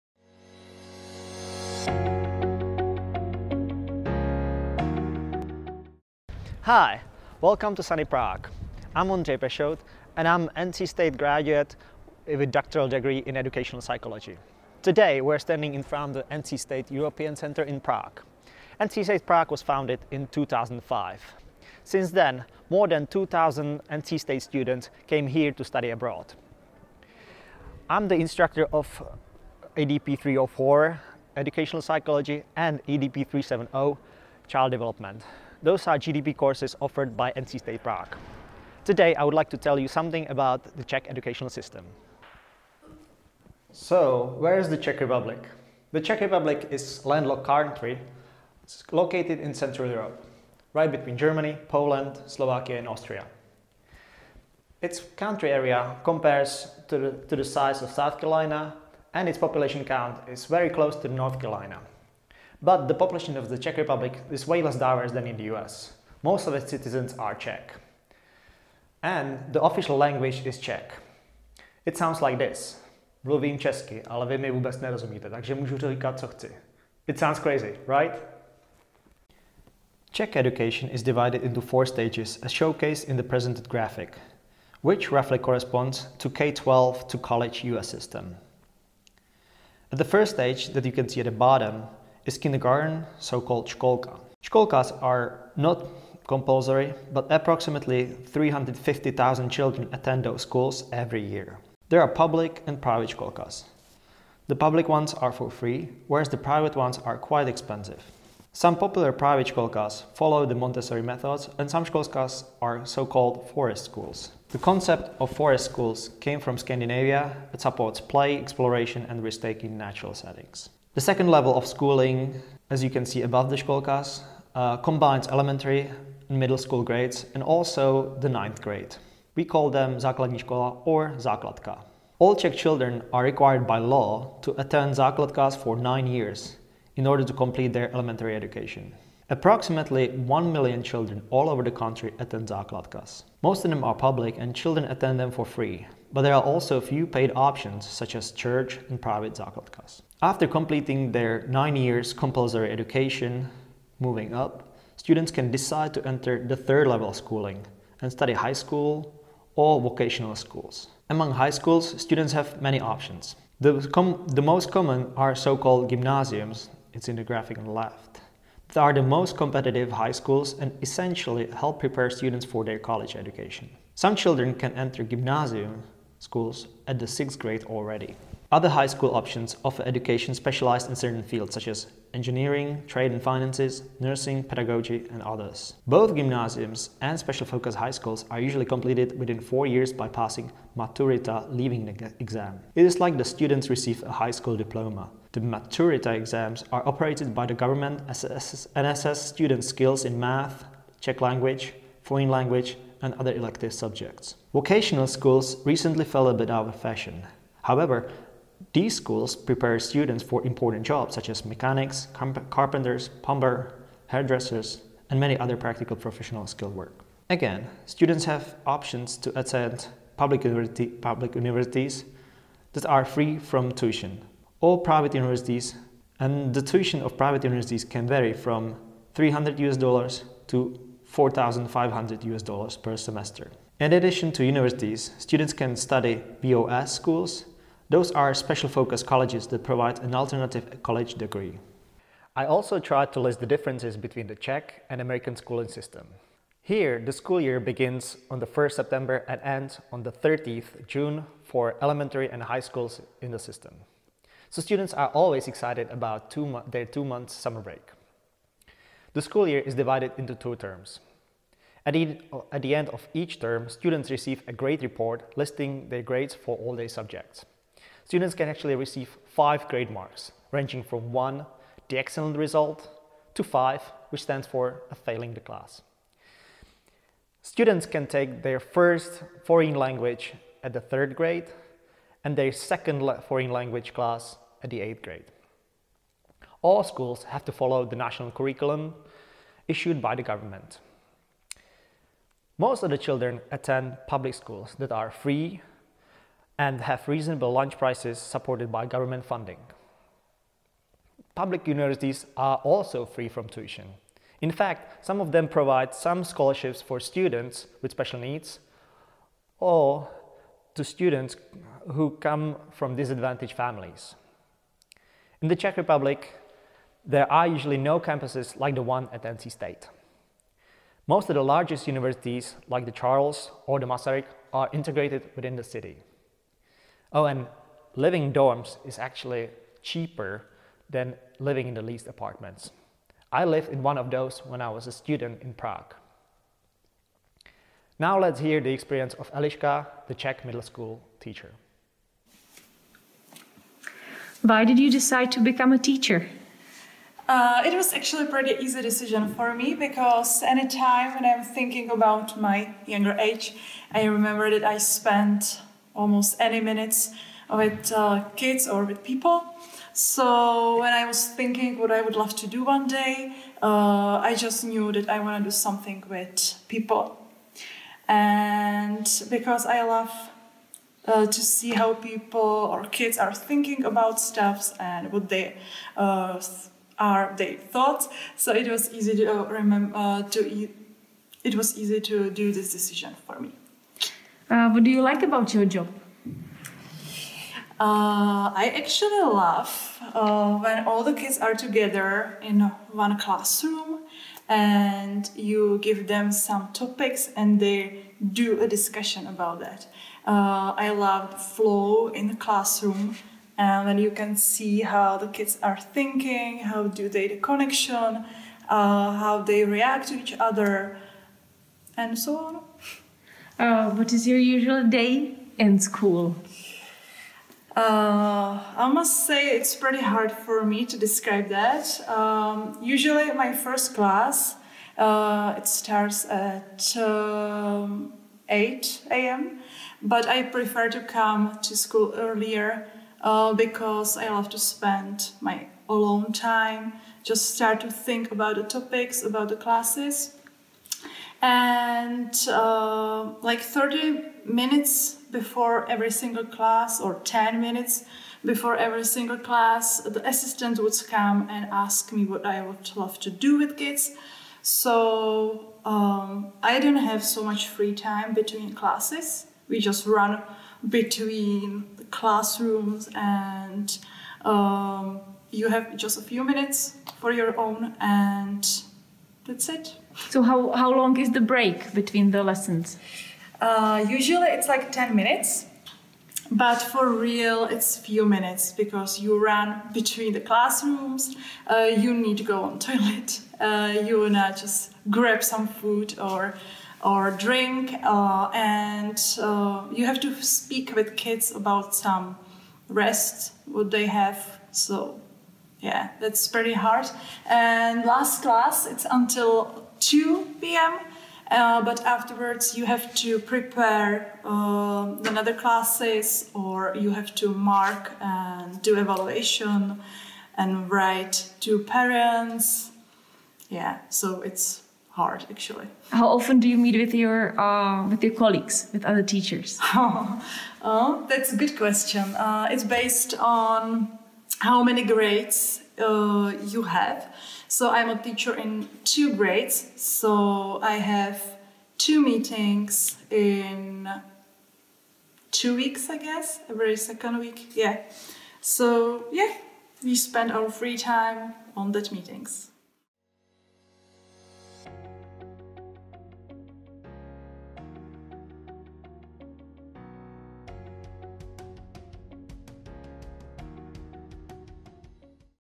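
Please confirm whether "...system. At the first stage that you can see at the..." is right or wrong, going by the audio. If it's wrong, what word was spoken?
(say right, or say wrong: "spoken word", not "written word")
right.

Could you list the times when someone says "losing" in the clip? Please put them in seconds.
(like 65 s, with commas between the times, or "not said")
not said.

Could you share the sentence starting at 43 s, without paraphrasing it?
So, where is the Czech Republic?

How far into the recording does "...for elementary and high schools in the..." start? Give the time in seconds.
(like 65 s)
251 s.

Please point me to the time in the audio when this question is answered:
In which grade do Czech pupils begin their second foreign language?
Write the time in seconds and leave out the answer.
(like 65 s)
284 s.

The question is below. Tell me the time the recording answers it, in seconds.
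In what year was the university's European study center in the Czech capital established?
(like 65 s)
20 s.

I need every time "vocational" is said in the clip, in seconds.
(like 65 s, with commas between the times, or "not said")
159 s, 204 s.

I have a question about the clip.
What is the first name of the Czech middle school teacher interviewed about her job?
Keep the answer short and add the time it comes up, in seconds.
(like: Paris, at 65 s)
Eliška, at 339 s.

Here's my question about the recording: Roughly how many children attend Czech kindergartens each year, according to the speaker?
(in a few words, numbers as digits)
350,000.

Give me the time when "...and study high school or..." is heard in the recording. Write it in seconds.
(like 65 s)
158 s.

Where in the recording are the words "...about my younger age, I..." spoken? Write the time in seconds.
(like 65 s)
351 s.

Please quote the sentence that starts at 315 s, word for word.
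In the Czech Republic, there are usually no campuses like the one at NC State.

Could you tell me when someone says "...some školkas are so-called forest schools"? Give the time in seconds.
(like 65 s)
111 s.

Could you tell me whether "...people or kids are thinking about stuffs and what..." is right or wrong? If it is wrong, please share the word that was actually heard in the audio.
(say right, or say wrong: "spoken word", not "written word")
right.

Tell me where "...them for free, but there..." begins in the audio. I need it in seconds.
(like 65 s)
145 s.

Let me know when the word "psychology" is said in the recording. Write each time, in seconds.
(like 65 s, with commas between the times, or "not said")
13 s, 31 s.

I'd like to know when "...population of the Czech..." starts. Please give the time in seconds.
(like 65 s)
62 s.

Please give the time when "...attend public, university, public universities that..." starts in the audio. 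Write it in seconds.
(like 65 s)
219 s.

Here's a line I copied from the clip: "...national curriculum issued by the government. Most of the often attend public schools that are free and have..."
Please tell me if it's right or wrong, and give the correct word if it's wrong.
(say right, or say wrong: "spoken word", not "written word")
wrong: "children", not "often".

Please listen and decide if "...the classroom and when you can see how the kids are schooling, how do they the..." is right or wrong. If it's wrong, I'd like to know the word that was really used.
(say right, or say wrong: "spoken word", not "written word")
wrong: "thinking", not "schooling".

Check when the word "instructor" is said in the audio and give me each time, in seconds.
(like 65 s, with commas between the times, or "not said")
28 s.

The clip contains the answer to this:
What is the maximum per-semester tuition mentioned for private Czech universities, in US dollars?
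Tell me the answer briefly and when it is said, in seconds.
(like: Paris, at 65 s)
$4,500, at 231 s.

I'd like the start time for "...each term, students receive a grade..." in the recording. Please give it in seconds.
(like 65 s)
263 s.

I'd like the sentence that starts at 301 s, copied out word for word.
Public universities are also free from tuition.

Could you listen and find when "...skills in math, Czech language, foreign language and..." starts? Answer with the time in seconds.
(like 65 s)
199 s.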